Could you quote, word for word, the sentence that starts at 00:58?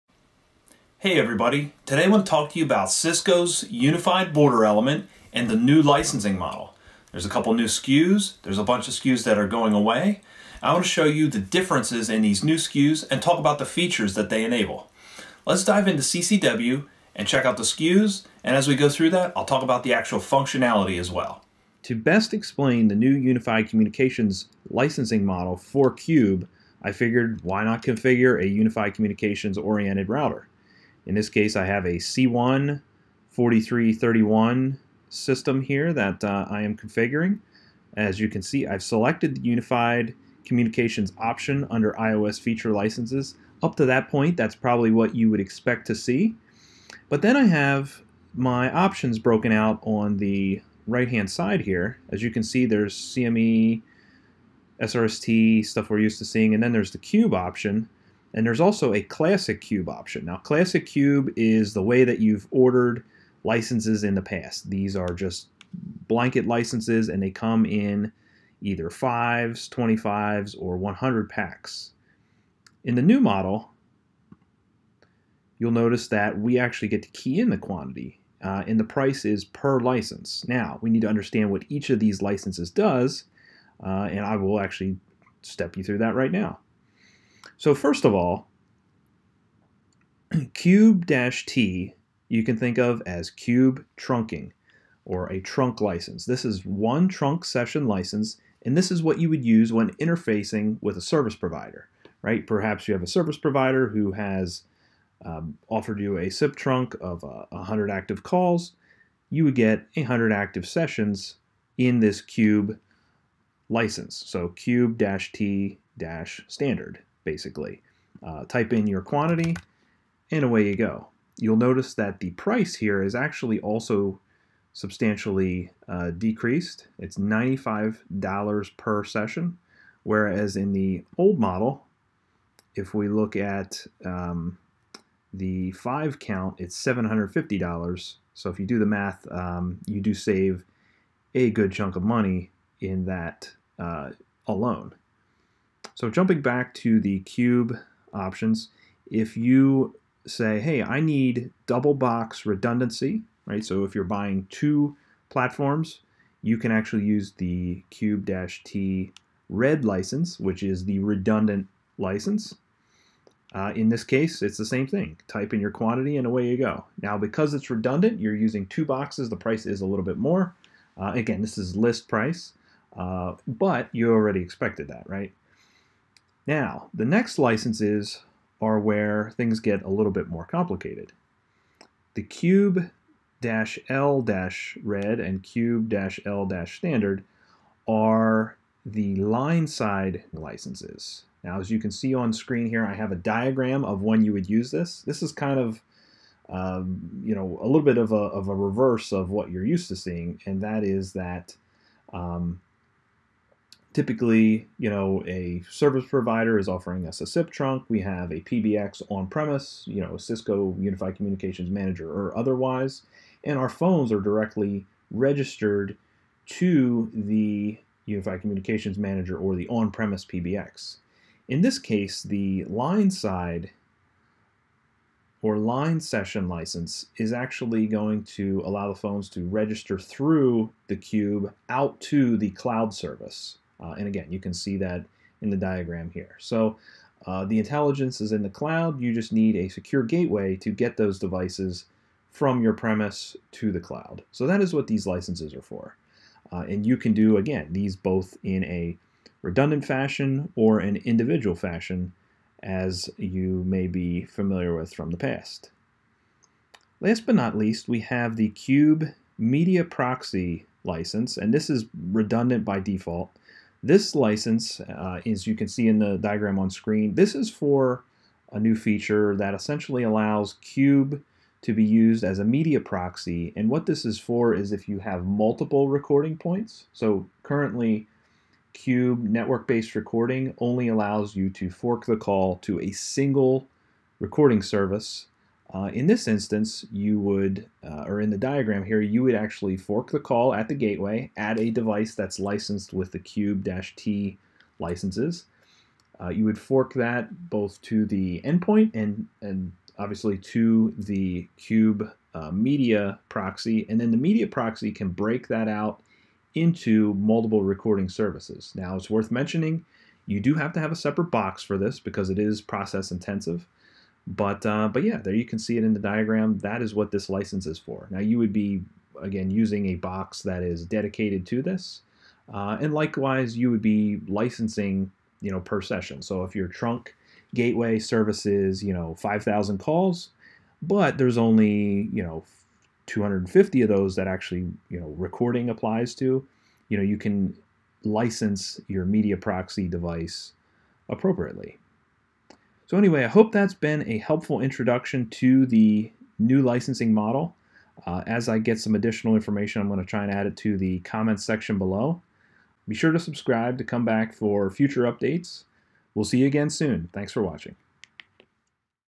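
And there's also a classic cube option.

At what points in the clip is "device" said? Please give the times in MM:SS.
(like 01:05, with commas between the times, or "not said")
04:01, 04:51, 05:39.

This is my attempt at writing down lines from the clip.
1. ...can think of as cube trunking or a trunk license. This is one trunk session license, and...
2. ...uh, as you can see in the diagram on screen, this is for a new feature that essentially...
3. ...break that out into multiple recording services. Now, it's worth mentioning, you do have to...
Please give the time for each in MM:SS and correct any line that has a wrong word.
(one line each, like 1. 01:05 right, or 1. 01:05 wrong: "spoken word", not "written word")
1. 01:32 right
2. 04:24 right
3. 05:05 right.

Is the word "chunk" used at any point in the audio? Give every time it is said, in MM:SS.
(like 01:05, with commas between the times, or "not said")
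02:21.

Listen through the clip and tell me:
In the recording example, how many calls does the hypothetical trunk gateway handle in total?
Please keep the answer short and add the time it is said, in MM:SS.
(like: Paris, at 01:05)
5,000, at 05:29.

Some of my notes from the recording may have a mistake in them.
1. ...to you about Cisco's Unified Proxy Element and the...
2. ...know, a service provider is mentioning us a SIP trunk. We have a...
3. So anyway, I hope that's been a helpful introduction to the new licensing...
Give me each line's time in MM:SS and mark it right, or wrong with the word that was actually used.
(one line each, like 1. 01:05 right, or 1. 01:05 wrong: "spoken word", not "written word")
1. 00:02 wrong: "Border", not "Proxy"
2. 03:24 wrong: "offering", not "mentioning"
3. 05:42 right.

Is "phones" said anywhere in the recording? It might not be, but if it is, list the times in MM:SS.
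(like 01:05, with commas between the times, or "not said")
03:33, 03:48.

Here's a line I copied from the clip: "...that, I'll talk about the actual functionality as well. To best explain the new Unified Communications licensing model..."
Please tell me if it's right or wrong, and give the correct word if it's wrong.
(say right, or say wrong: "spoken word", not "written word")
right.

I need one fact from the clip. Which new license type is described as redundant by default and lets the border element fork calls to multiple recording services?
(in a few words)
Cube Media Proxy.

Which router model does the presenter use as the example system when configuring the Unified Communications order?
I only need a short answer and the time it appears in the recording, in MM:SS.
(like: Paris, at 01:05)
C1 4331, at 00:31.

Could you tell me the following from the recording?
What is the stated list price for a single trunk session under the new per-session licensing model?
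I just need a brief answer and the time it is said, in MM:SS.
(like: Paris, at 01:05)
$95, at 02:07.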